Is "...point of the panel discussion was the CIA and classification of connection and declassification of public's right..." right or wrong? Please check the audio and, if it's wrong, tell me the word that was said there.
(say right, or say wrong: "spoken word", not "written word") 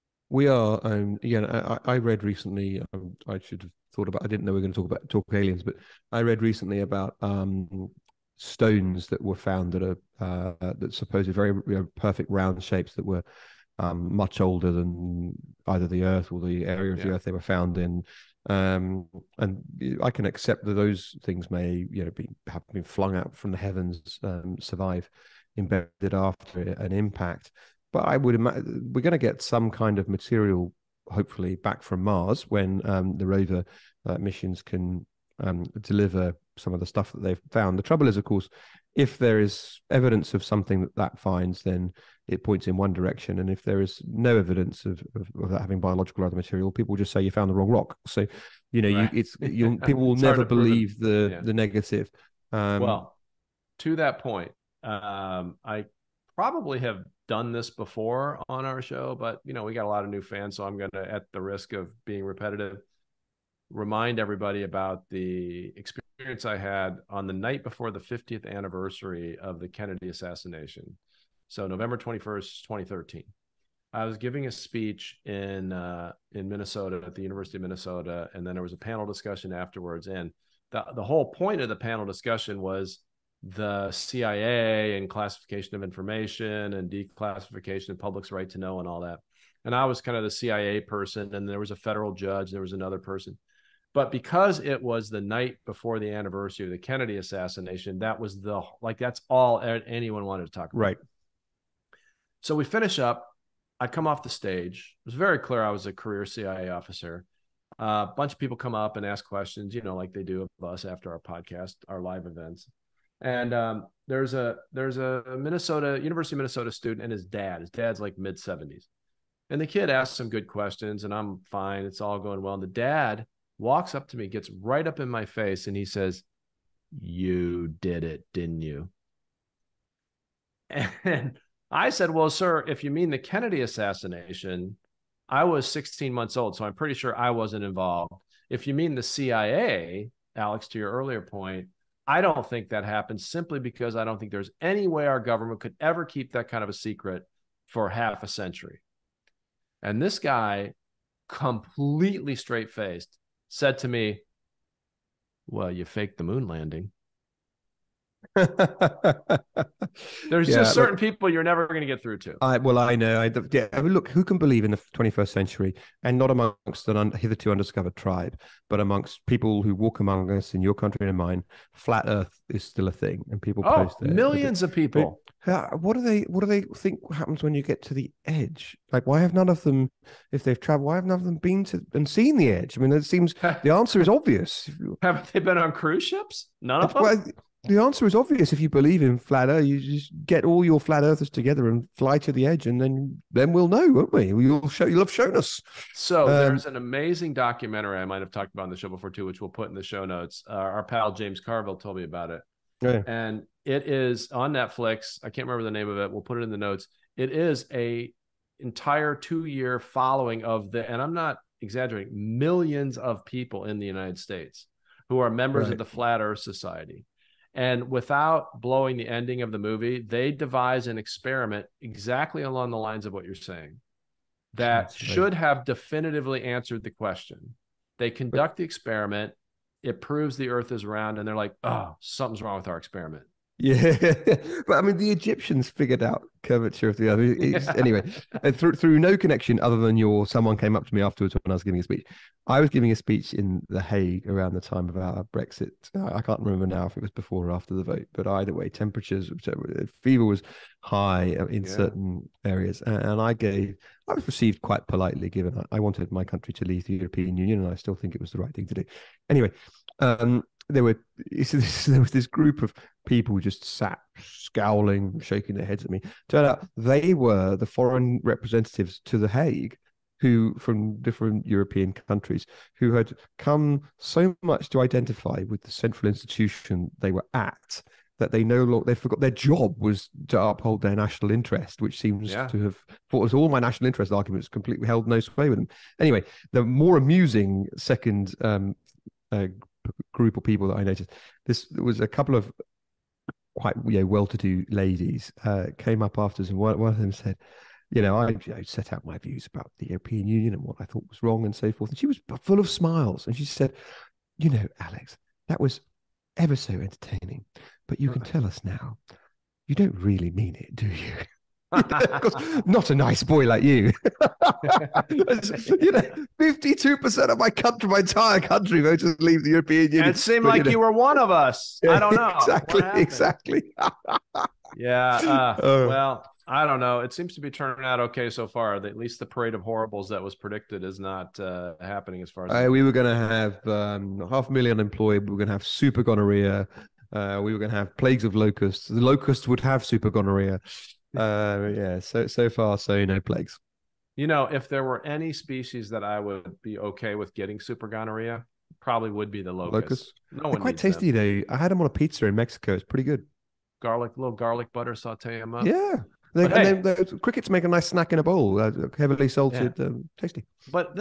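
wrong: "information", not "connection".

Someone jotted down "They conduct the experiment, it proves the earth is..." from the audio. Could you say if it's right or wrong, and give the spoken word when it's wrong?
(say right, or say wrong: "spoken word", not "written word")
right.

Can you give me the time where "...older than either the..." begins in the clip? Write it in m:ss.
0:14.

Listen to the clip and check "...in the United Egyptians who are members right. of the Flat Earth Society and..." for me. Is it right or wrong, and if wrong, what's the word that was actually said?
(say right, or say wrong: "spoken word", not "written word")
wrong: "States", not "Egyptians".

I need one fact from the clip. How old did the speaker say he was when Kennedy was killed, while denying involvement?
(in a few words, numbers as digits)
16 months.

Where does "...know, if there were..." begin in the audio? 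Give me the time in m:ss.
5:44.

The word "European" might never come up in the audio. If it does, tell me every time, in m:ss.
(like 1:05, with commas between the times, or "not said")
4:16, 4:31, 4:59, 5:19.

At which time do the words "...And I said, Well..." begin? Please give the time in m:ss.
2:11.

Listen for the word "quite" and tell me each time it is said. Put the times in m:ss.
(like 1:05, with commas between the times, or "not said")
4:14, 4:53, 5:50.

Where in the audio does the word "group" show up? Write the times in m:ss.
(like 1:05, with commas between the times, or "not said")
4:22, 4:50.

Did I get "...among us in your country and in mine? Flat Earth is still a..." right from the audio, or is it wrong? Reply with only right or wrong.
right.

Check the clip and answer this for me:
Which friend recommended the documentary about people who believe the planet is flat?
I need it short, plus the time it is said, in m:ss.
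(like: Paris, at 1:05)
James Carville, at 3:21.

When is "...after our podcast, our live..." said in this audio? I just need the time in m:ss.
1:50.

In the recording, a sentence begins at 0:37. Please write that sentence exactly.
The trouble is, of course, if there is evidence of something that that finds, then it points in one direction.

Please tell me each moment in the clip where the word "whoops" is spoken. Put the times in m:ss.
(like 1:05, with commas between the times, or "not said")
not said.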